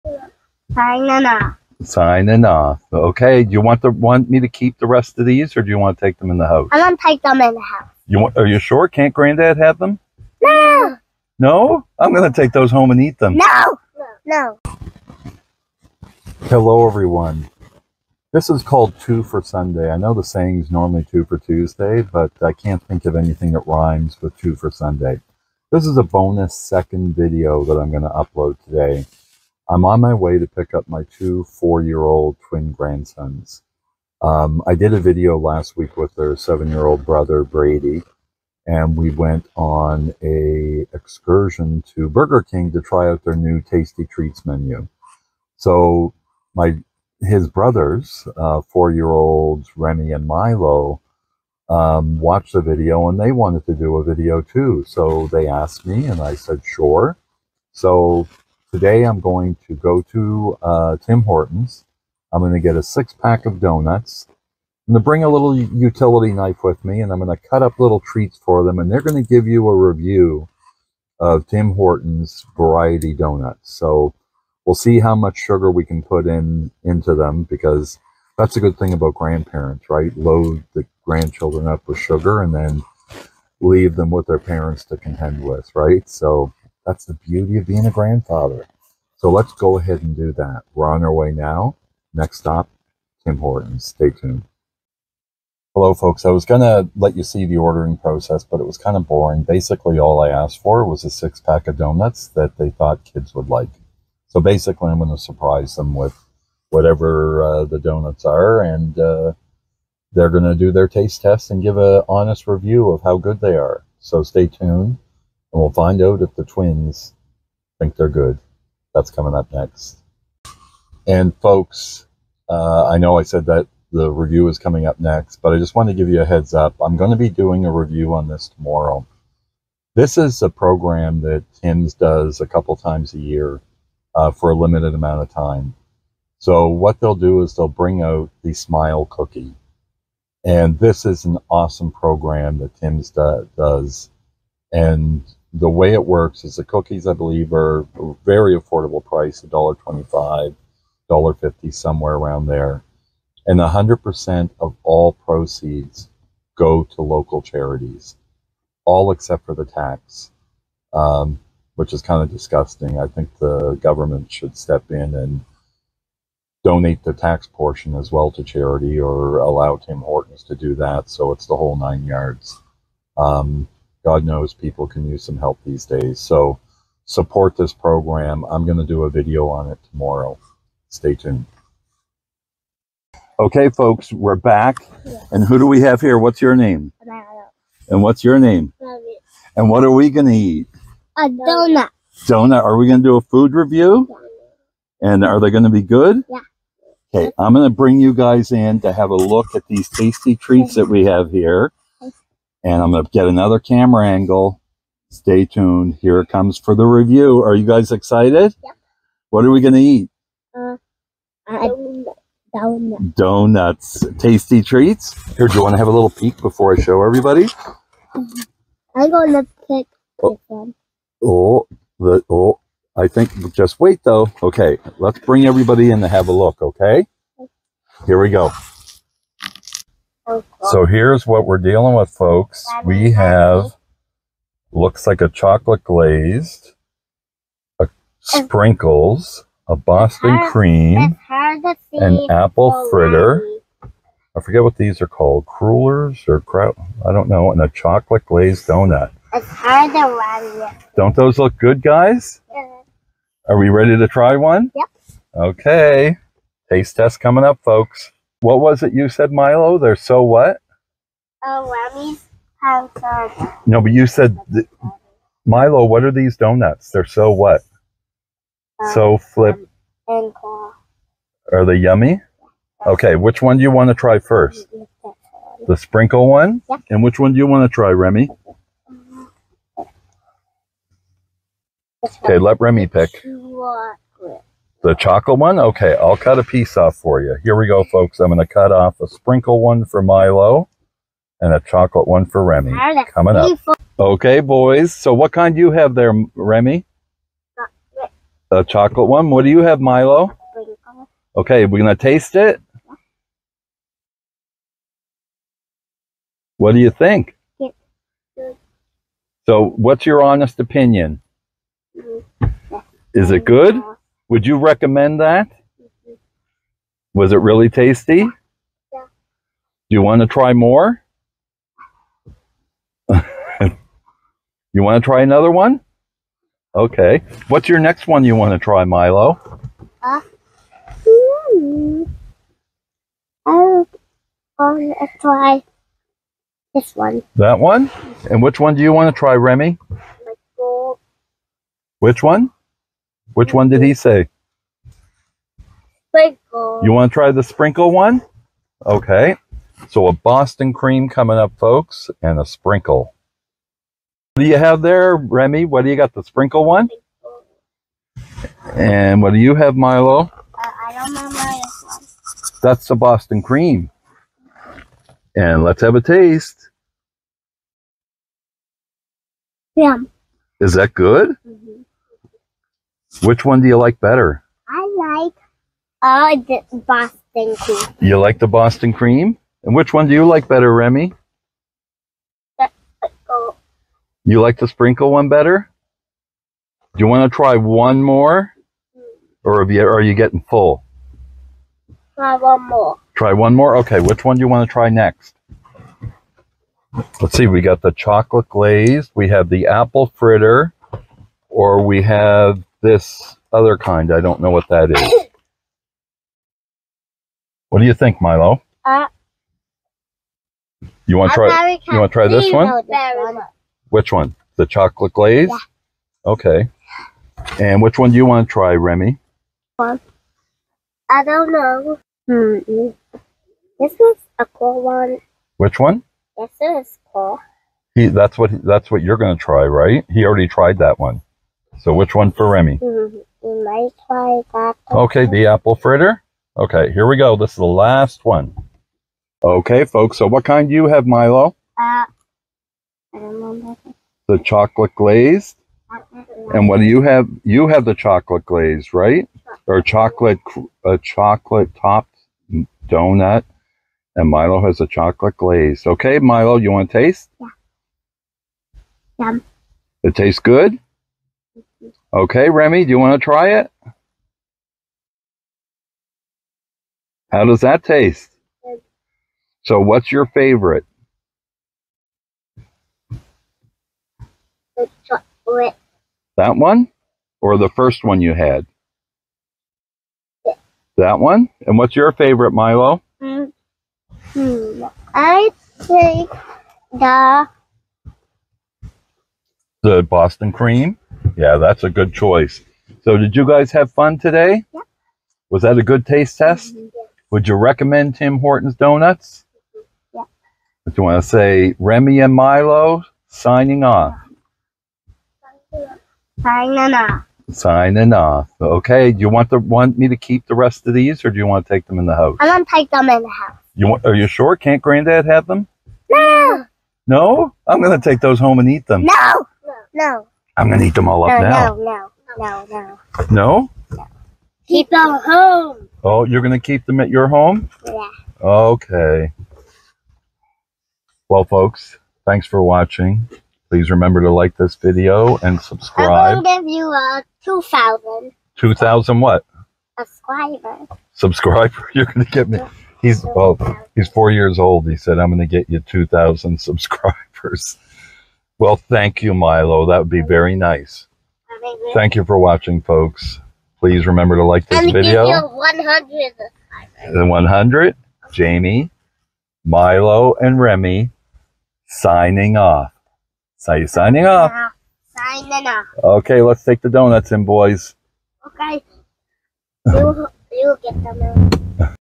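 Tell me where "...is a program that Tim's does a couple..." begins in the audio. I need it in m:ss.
2:10.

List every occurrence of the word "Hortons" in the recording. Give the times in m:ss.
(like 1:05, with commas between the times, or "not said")
1:01, 1:11, 1:33, 2:50, 8:18.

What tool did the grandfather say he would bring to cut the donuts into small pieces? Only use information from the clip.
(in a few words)
utility knife.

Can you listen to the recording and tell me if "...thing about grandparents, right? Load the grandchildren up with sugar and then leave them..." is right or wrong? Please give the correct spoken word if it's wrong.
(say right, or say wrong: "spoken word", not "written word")
right.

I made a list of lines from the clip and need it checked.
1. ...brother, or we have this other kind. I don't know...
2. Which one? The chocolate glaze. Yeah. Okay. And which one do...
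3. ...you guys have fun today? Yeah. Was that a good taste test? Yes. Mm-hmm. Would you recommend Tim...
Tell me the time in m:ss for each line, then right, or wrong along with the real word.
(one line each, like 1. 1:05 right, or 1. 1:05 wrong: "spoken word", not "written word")
1. 6:40 wrong: "fritter", not "brother"
2. 6:53 right
3. 8:13 right.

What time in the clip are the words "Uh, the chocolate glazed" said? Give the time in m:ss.
7:21.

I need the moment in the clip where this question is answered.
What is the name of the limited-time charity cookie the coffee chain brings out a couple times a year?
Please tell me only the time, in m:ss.
2:18.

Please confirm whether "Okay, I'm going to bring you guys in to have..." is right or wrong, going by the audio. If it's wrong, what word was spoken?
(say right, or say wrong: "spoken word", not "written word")
right.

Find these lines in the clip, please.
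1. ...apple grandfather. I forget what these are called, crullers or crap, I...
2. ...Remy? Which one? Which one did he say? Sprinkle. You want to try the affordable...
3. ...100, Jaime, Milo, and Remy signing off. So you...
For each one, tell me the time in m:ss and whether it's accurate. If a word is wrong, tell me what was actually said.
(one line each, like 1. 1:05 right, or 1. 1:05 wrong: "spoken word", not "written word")
1. 4:02 wrong: "fritter", not "grandfather"
2. 5:39 wrong: "sprinkle", not "affordable"
3. 9:17 right.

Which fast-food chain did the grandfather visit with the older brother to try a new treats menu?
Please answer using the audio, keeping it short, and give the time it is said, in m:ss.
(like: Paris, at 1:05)
Burger King, at 0:42.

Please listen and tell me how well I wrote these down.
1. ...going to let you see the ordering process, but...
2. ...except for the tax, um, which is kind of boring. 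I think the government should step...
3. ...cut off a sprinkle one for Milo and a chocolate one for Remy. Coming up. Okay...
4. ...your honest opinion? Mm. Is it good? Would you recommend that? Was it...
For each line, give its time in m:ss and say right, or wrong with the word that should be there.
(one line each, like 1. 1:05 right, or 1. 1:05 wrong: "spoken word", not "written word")
1. 1:36 right
2. 2:39 wrong: "disgusting", not "boring"
3. 4:48 right
4. 5:10 right.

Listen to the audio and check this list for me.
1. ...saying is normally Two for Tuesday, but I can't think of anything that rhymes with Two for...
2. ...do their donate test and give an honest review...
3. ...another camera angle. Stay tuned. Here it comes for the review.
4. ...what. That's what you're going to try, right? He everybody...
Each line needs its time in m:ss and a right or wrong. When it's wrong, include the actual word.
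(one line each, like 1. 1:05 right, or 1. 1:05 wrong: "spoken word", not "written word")
1. 0:20 right
2. 1:50 wrong: "taste", not "donate"
3. 3:23 right
4. 7:08 wrong: "already", not "everybody".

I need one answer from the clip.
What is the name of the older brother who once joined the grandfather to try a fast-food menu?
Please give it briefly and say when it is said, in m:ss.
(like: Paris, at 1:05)
Brady, at 0:37.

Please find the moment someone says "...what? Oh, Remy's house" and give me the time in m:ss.
4:20.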